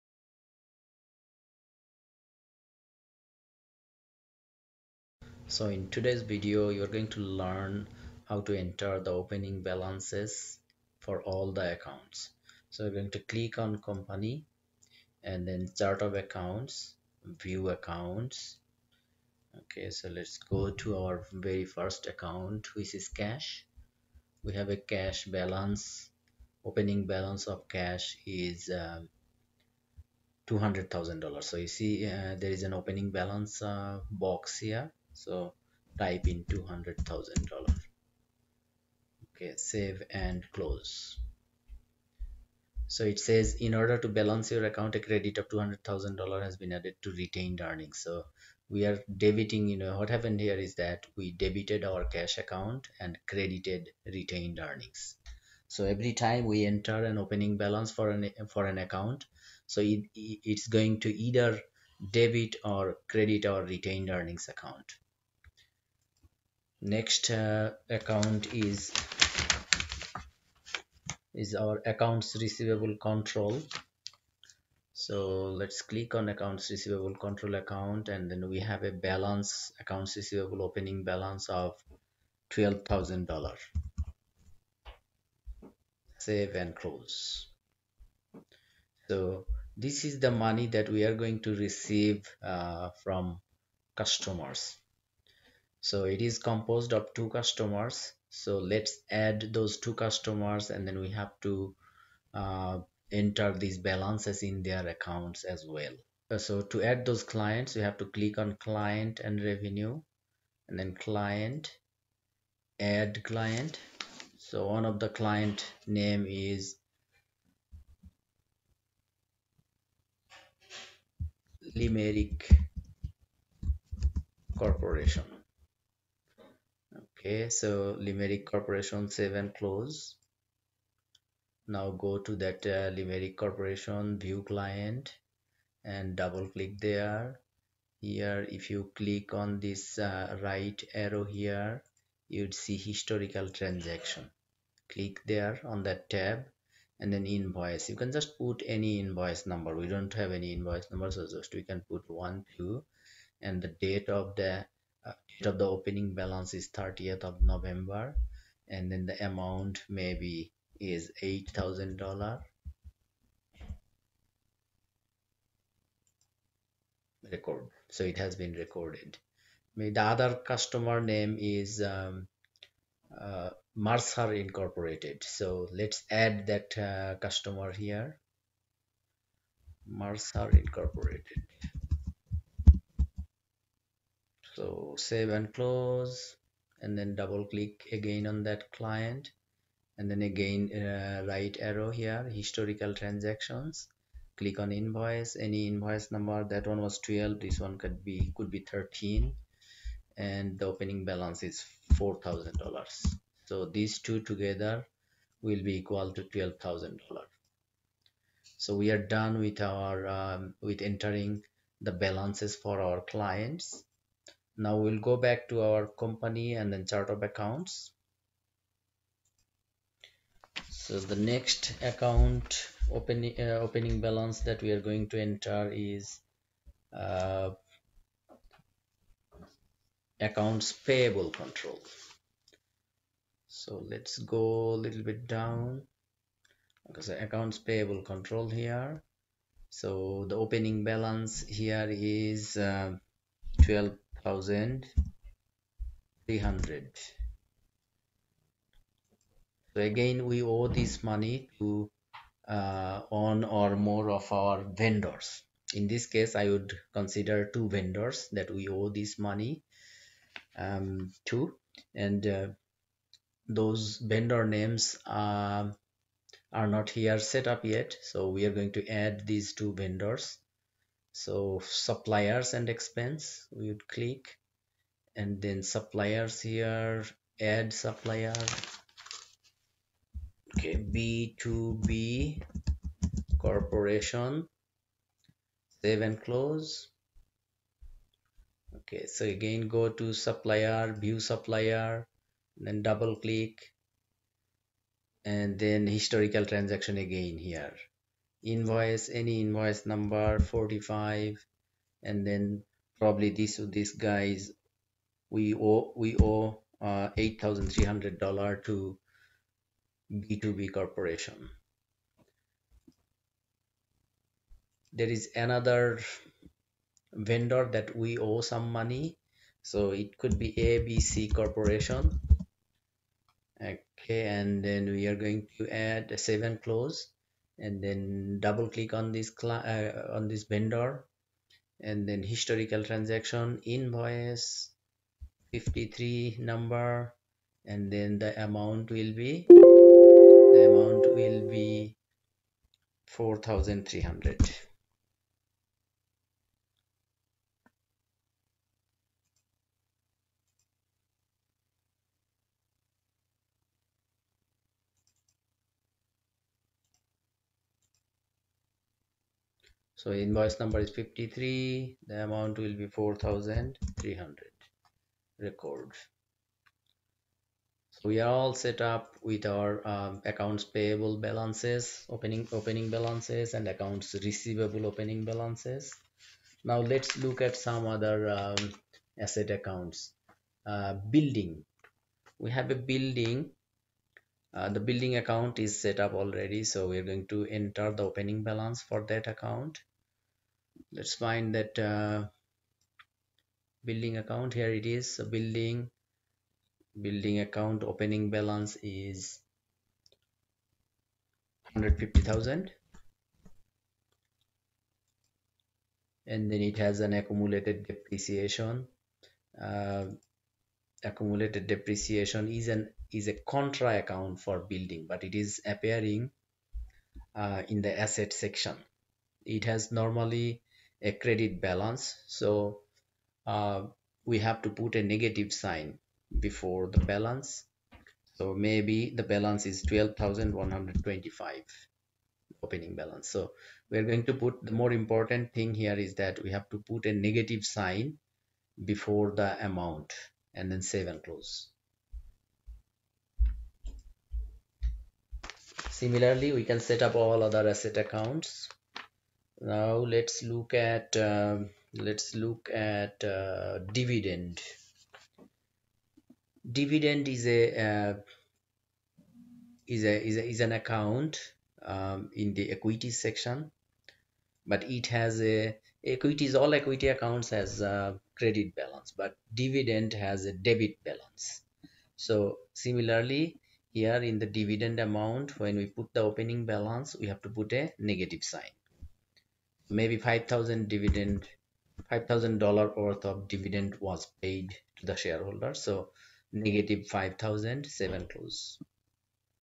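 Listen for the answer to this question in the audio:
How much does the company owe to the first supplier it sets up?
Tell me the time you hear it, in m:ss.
5:07.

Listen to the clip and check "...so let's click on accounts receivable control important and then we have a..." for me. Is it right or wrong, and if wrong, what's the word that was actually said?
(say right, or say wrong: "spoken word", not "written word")
wrong: "account", not "important".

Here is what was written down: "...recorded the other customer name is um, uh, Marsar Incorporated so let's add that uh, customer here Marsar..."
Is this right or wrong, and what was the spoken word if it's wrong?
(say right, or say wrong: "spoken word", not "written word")
right.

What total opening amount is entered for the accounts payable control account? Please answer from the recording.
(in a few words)
$12,300.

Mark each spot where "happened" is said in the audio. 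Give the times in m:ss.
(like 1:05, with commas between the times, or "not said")
0:50.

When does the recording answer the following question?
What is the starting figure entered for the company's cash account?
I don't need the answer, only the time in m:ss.
0:36.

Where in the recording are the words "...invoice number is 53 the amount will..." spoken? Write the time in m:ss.
6:00.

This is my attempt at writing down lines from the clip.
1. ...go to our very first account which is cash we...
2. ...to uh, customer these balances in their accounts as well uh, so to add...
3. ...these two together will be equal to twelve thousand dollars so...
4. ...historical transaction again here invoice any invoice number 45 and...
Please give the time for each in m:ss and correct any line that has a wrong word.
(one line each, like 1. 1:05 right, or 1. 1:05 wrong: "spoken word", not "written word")
1. 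0:20 right
2. 1:41 wrong: "enter", not "customer"
3. 3:23 right
4. 4:55 right.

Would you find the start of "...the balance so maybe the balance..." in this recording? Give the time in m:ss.
7:06.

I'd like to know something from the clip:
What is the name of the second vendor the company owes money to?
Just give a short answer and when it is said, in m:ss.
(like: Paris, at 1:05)
ABC Corporation, at 5:20.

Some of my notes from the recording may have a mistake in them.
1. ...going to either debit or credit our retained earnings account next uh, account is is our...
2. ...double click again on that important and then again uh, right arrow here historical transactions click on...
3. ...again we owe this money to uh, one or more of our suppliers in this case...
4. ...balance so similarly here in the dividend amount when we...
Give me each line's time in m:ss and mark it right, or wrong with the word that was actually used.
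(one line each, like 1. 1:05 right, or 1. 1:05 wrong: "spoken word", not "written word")
1. 1:00 right
2. 3:07 wrong: "client", not "important"
3. 4:09 wrong: "vendors", not "suppliers"
4. 7:51 right.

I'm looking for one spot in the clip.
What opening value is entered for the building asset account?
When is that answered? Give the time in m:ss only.
6:41.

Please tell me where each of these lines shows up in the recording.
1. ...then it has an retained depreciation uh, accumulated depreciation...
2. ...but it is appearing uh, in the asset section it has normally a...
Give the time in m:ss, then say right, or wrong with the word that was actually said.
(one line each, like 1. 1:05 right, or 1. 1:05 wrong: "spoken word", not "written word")
1. 6:46 wrong: "accumulated", not "retained"
2. 6:55 right.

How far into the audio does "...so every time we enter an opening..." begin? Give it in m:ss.
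0:55.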